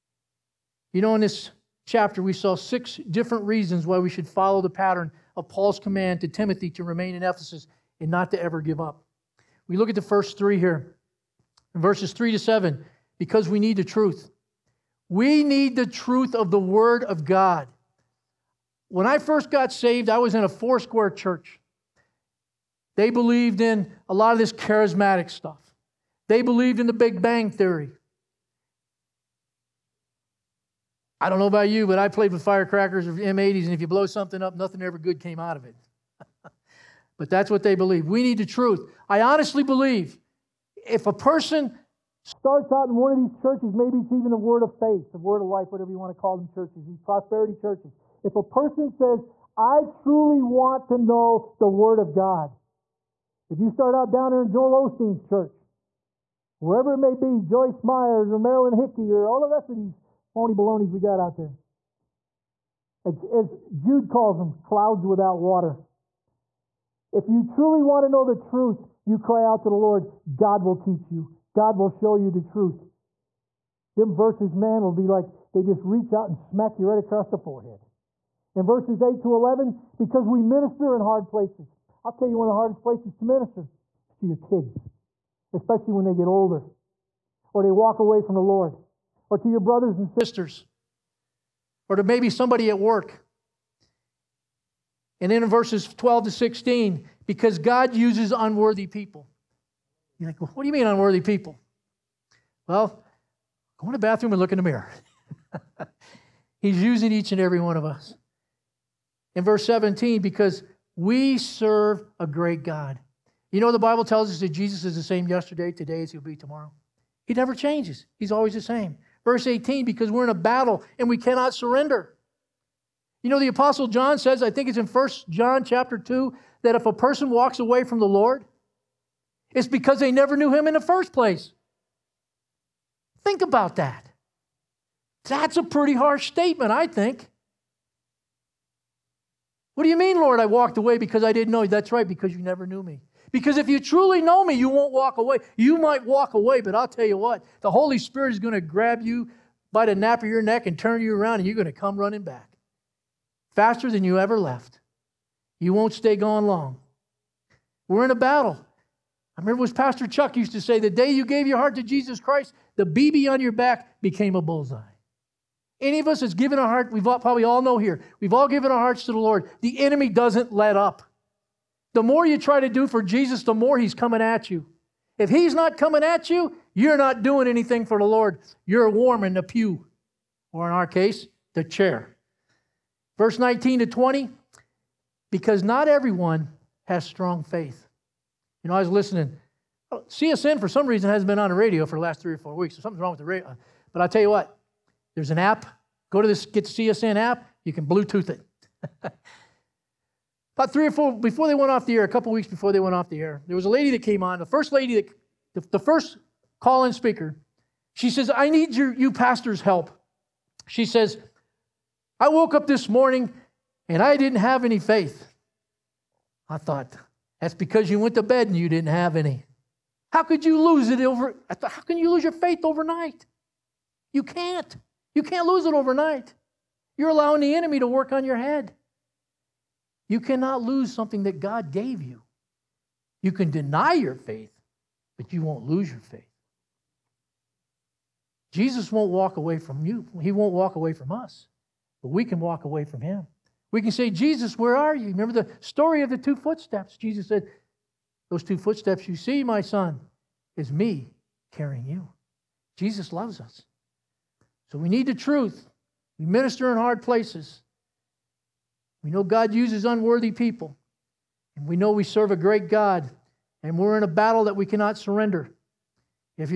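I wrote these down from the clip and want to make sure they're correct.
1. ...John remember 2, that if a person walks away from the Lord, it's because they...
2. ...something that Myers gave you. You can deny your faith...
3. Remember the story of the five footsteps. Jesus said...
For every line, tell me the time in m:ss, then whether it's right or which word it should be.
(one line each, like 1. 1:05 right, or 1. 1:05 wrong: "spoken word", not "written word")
1. 2:05 wrong: "chapter", not "remember"
2. 3:50 wrong: "God", not "Myers"
3. 4:05 wrong: "two", not "five".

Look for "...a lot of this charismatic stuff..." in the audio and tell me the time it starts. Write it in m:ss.
0:24.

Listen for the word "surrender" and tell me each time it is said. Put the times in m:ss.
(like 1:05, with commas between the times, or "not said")
2:01, 4:24.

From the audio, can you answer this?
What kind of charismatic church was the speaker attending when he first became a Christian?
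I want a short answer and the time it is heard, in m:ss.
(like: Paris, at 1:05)
Four square church, at 0:20.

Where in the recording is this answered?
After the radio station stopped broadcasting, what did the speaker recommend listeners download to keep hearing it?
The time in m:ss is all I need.
3:16.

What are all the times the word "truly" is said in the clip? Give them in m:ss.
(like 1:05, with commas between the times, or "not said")
0:49, 1:07, 2:23.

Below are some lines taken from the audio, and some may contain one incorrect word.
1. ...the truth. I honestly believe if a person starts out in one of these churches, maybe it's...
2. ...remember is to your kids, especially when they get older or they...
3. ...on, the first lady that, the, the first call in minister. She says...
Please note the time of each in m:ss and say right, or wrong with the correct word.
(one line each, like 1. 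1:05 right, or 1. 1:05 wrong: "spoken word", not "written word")
1. 0:38 right
2. 1:23 wrong: "minister", not "remember"
3. 3:24 wrong: "speaker", not "minister".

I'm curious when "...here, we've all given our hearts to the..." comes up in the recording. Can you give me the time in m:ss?
2:47.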